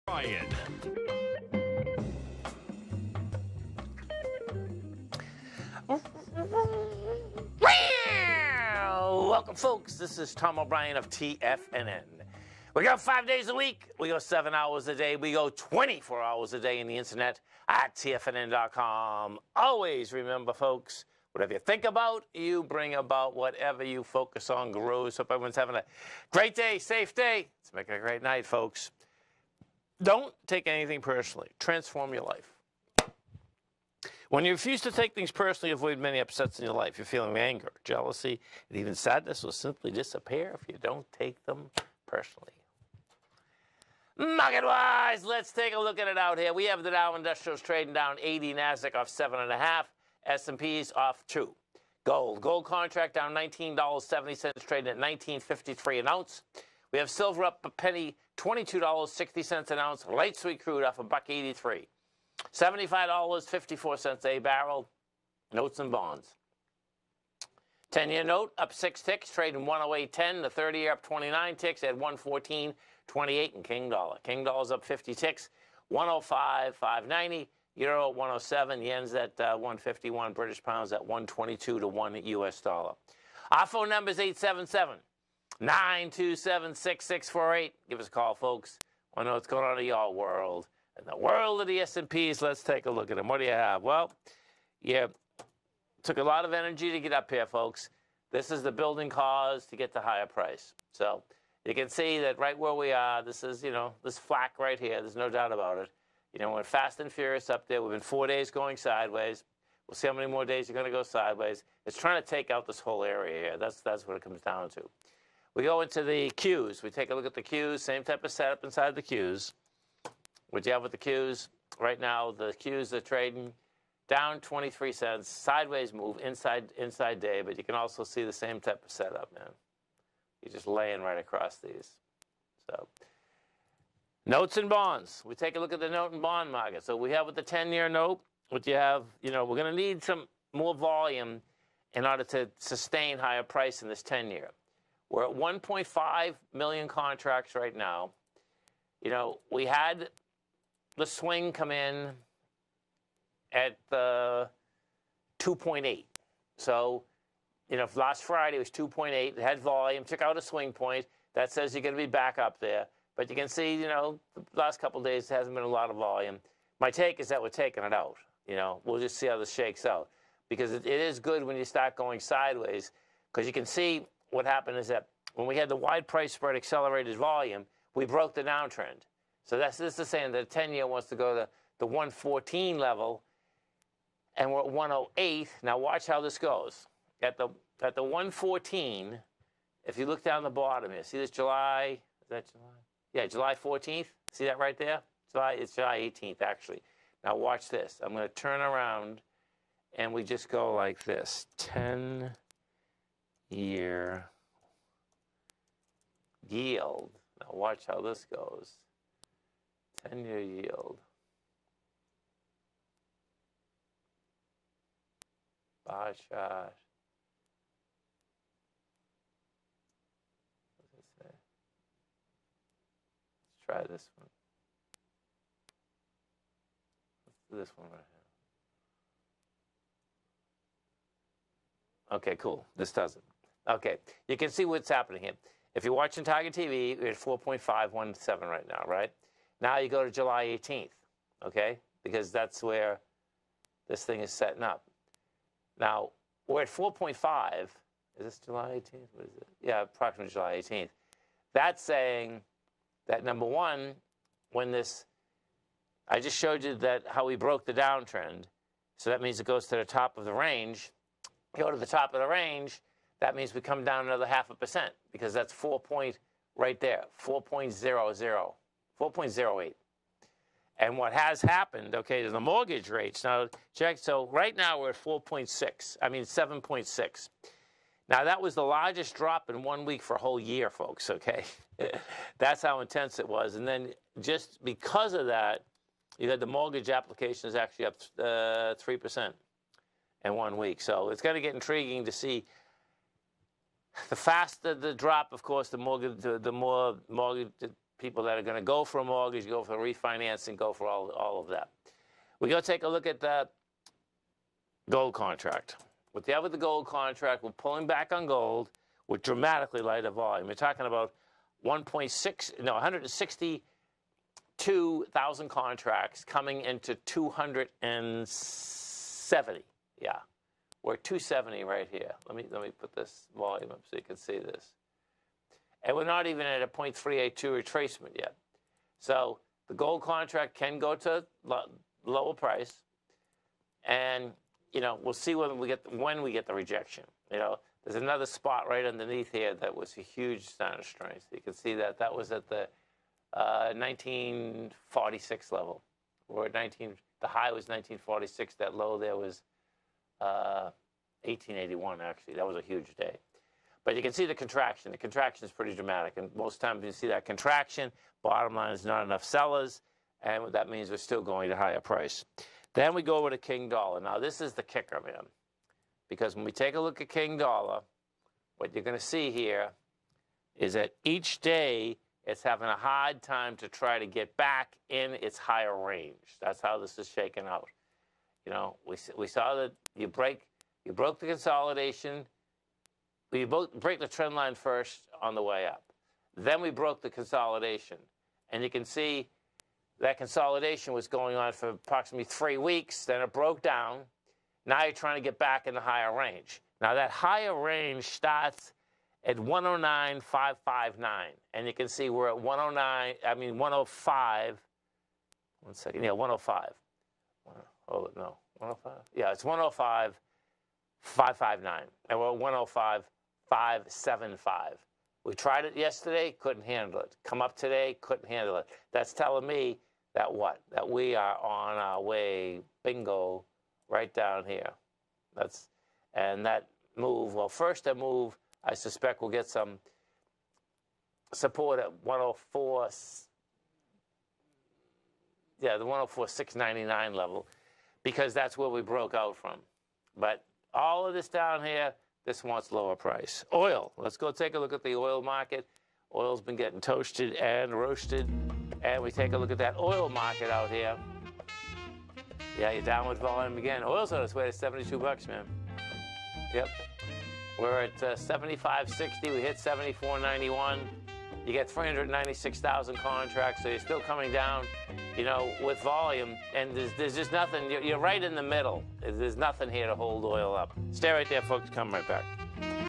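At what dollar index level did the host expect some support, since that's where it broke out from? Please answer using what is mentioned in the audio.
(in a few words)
104.699.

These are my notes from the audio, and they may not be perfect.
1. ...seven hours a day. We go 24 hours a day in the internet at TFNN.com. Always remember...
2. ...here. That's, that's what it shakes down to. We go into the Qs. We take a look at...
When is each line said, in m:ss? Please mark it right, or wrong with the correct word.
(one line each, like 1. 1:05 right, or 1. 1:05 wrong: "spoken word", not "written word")
1. 0:14 right
2. 1:53 wrong: "comes", not "shakes".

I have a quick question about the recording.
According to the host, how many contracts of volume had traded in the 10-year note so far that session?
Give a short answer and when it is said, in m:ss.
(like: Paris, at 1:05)
1.5 million, at 2:25.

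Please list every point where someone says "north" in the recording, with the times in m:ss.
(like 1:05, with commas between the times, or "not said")
not said.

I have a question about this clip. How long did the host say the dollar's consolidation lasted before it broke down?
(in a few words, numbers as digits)
three weeks.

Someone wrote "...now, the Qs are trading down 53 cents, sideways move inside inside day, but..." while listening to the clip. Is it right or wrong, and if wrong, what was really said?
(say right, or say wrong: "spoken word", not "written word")
wrong: "23", not "53".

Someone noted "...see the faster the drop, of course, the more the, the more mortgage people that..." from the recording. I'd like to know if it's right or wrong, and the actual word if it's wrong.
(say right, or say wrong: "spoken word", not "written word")
right.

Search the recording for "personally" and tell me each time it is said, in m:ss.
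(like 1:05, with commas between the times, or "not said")
0:31, 0:35, 0:42.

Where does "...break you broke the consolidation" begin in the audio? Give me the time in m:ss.
6:20.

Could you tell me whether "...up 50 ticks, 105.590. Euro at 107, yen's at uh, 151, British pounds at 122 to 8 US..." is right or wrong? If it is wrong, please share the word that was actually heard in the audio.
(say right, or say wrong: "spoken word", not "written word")
wrong: "1", not "8".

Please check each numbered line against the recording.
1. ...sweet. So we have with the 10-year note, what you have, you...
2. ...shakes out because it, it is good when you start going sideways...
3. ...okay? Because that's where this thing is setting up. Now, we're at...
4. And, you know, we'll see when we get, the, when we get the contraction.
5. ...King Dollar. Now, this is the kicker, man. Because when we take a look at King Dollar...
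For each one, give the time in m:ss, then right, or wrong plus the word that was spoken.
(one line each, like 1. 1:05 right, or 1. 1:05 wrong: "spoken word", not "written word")
1. 2:16 wrong: "market", not "sweet"
2. 2:49 right
3. 4:01 right
4. 5:33 wrong: "rejection", not "contraction"
5. 6:03 right.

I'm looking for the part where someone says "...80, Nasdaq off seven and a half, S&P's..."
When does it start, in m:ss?
0:48.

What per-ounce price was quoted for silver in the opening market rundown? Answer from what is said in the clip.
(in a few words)
$22.60.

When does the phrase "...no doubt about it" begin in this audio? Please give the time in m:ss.
1:45.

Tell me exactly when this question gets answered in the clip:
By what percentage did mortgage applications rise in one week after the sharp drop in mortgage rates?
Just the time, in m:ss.
4:48.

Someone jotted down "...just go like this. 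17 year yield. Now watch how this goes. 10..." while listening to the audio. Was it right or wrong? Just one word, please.
wrong.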